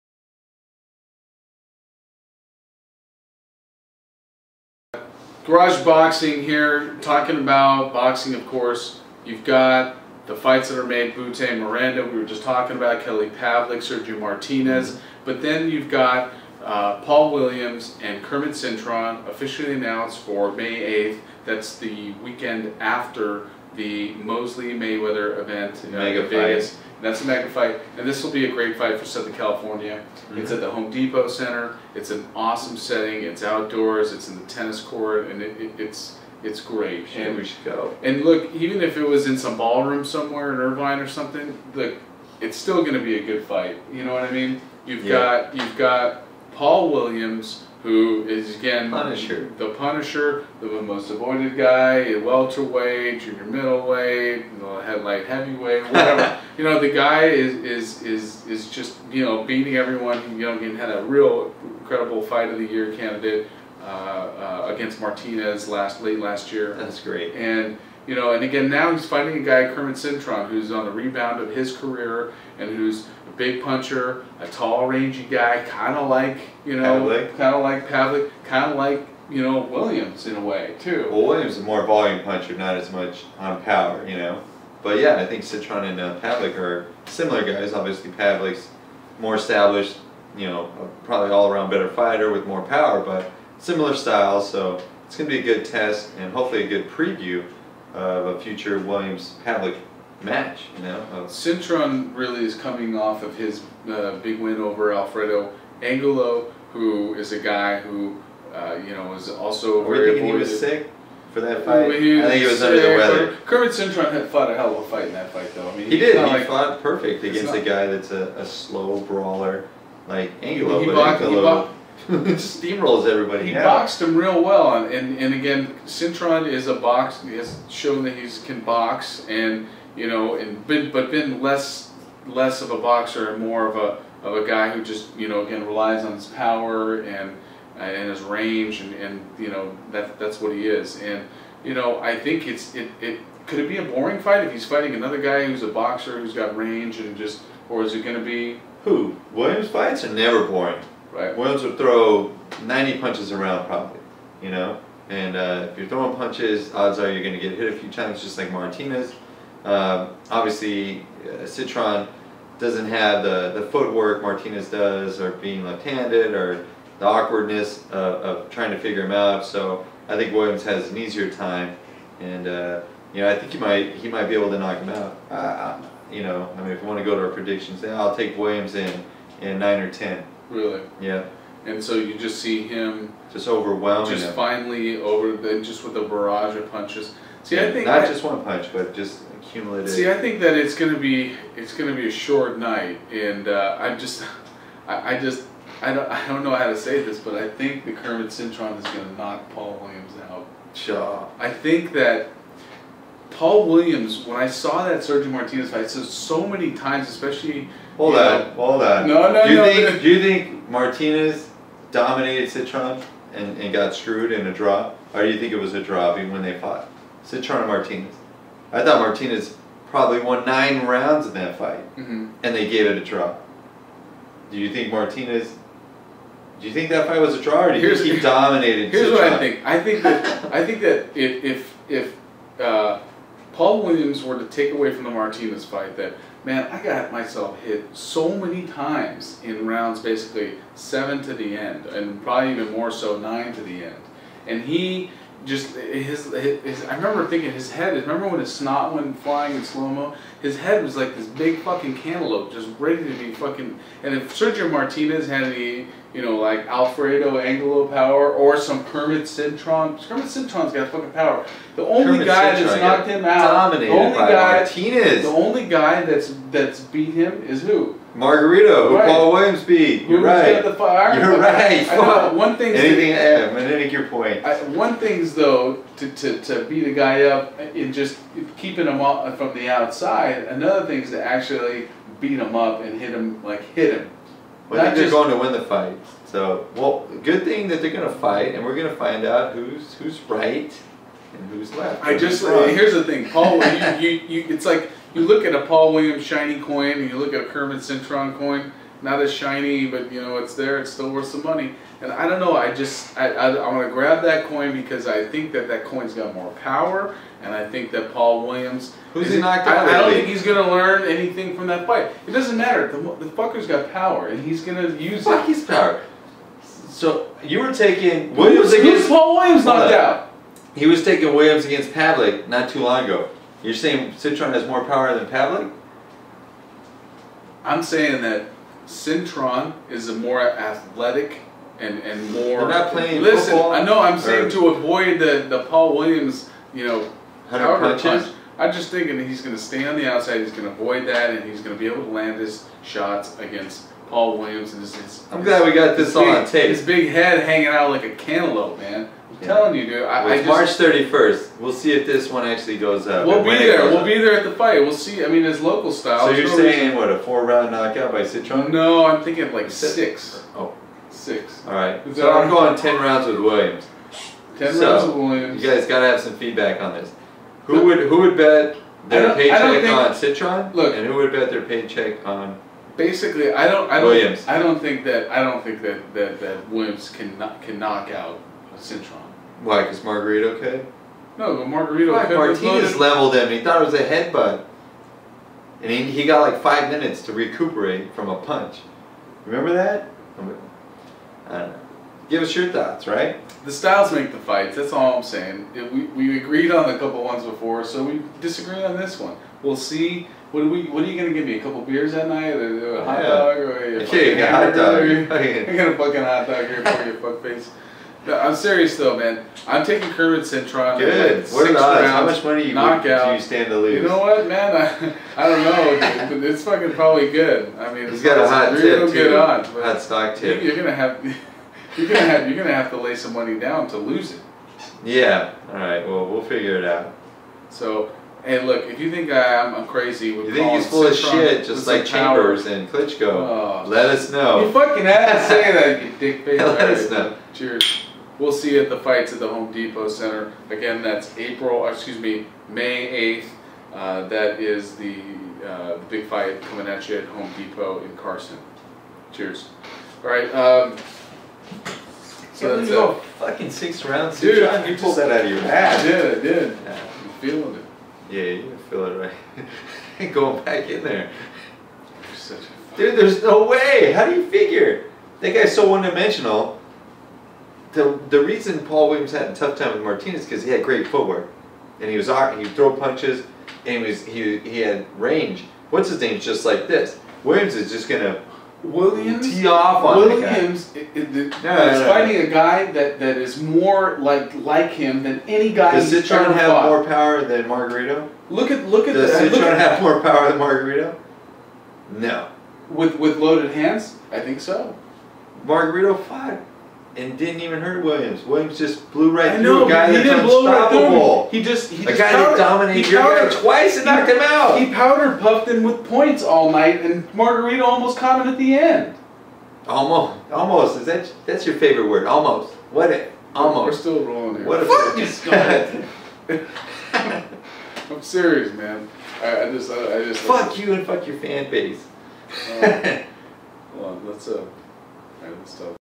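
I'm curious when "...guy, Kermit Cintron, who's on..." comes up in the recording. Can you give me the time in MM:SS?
01:09.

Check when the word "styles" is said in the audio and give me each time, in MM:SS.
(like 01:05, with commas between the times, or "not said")
01:33, 05:55, 06:33.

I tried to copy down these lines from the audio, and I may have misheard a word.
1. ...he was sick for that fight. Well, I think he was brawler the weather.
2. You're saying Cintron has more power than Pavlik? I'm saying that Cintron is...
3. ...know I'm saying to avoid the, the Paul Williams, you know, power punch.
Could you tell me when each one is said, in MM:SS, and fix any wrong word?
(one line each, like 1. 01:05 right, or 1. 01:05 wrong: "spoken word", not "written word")
1. 01:50 wrong: "under", not "brawler"
2. 05:23 right
3. 05:33 right.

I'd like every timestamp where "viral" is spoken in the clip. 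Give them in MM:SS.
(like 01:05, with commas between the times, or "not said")
not said.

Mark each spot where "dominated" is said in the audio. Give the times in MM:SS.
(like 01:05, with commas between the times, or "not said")
03:31, 03:48, 04:23, 08:22.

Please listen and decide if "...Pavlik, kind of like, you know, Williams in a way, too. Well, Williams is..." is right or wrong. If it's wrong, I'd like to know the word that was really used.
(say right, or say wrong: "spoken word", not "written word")
right.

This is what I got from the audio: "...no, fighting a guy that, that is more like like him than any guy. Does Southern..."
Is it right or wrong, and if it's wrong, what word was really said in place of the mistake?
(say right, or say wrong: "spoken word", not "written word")
wrong: "Cintron", not "Southern".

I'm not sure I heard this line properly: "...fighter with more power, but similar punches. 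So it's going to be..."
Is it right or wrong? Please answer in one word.
wrong.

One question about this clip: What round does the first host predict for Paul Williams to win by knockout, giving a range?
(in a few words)
9 or 10.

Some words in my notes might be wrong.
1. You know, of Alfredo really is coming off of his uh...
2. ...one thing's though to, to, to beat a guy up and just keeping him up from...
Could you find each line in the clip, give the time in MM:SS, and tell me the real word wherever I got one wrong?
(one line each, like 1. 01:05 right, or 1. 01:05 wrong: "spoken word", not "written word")
1. 01:40 wrong: "Cintron", not "Alfredo"
2. 04:34 right.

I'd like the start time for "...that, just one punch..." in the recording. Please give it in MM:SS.
03:08.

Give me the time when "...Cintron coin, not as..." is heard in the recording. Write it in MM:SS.
04:57.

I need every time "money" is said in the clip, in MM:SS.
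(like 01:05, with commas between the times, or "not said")
05:01, 06:52, 07:03.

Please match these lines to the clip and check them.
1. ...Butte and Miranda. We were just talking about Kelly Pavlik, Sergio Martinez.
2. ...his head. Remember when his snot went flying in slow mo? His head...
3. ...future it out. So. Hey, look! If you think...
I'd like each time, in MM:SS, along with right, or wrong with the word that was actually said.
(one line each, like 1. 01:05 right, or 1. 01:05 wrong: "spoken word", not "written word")
1. 00:11 right
2. 04:07 right
3. 07:06 wrong: "figure", not "future".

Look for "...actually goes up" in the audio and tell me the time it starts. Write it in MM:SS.
05:52.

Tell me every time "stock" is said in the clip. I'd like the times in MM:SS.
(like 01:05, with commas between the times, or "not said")
07:00.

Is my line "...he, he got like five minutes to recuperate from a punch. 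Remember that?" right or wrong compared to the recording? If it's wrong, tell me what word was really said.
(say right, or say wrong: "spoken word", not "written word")
right.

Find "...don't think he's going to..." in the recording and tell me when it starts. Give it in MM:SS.
05:10.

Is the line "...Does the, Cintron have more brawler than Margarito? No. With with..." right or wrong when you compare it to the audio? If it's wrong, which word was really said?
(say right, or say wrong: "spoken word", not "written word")
wrong: "power", not "brawler".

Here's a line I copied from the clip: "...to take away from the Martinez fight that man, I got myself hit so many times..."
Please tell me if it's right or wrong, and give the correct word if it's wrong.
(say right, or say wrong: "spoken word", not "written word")
right.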